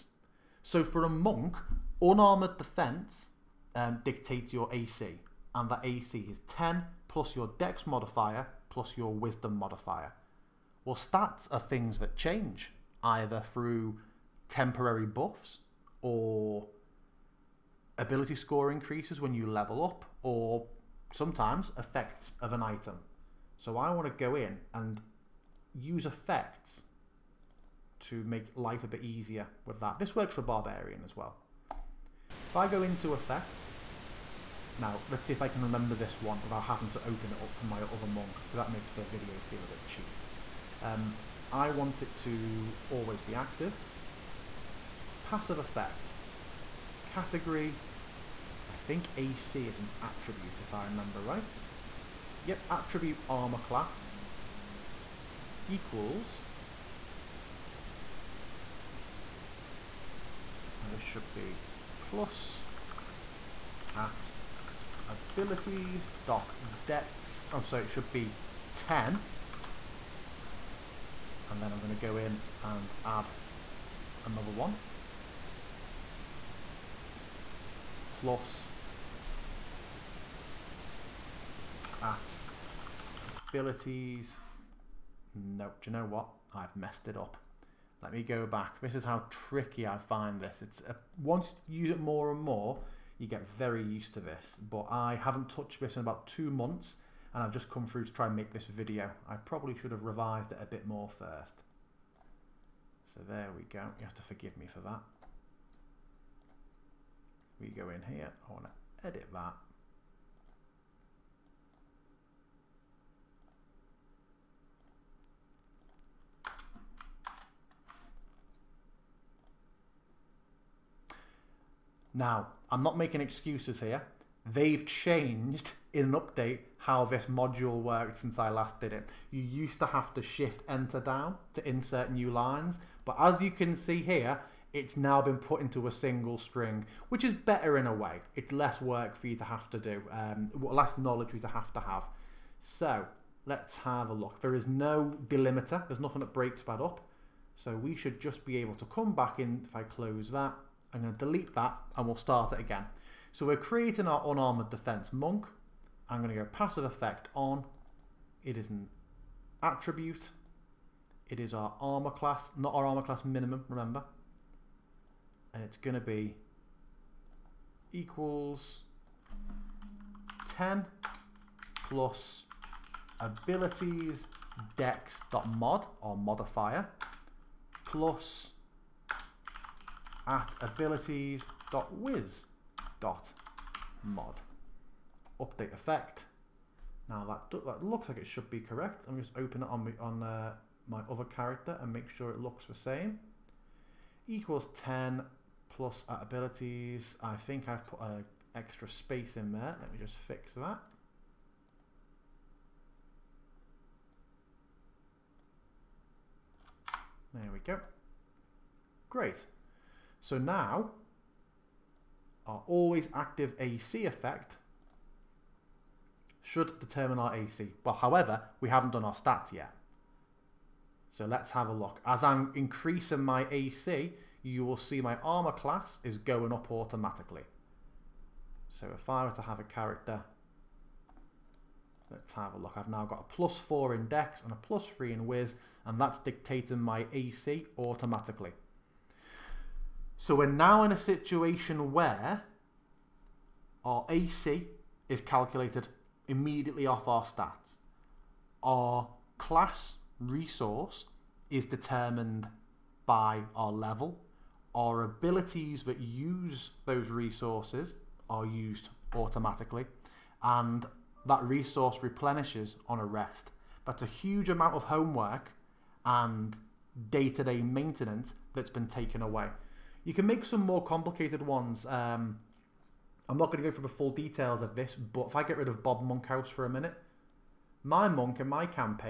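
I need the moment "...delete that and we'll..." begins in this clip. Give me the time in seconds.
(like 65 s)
151 s.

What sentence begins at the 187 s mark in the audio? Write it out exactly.
Now that that looks like it should be correct.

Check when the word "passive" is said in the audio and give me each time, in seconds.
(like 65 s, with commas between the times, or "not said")
45 s, 156 s.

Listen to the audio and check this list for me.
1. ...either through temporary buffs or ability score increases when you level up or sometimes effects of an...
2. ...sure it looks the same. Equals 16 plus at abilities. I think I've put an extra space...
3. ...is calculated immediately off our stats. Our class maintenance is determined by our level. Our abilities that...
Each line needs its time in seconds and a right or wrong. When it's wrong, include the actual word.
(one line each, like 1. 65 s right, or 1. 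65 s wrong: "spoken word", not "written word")
1. 13 s right
2. 192 s wrong: "10", not "16"
3. 245 s wrong: "resource", not "maintenance".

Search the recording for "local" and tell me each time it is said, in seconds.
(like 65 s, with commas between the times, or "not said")
not said.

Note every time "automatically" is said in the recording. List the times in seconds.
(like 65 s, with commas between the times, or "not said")
226 s, 237 s, 259 s.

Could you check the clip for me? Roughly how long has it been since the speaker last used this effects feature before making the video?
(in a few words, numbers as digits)
about two months.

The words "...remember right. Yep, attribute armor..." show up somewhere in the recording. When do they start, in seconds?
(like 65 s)
50 s.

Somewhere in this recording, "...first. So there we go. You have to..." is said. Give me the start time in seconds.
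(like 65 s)
101 s.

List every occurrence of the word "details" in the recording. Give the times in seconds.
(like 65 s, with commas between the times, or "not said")
274 s.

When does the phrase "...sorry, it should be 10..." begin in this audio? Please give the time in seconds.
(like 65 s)
67 s.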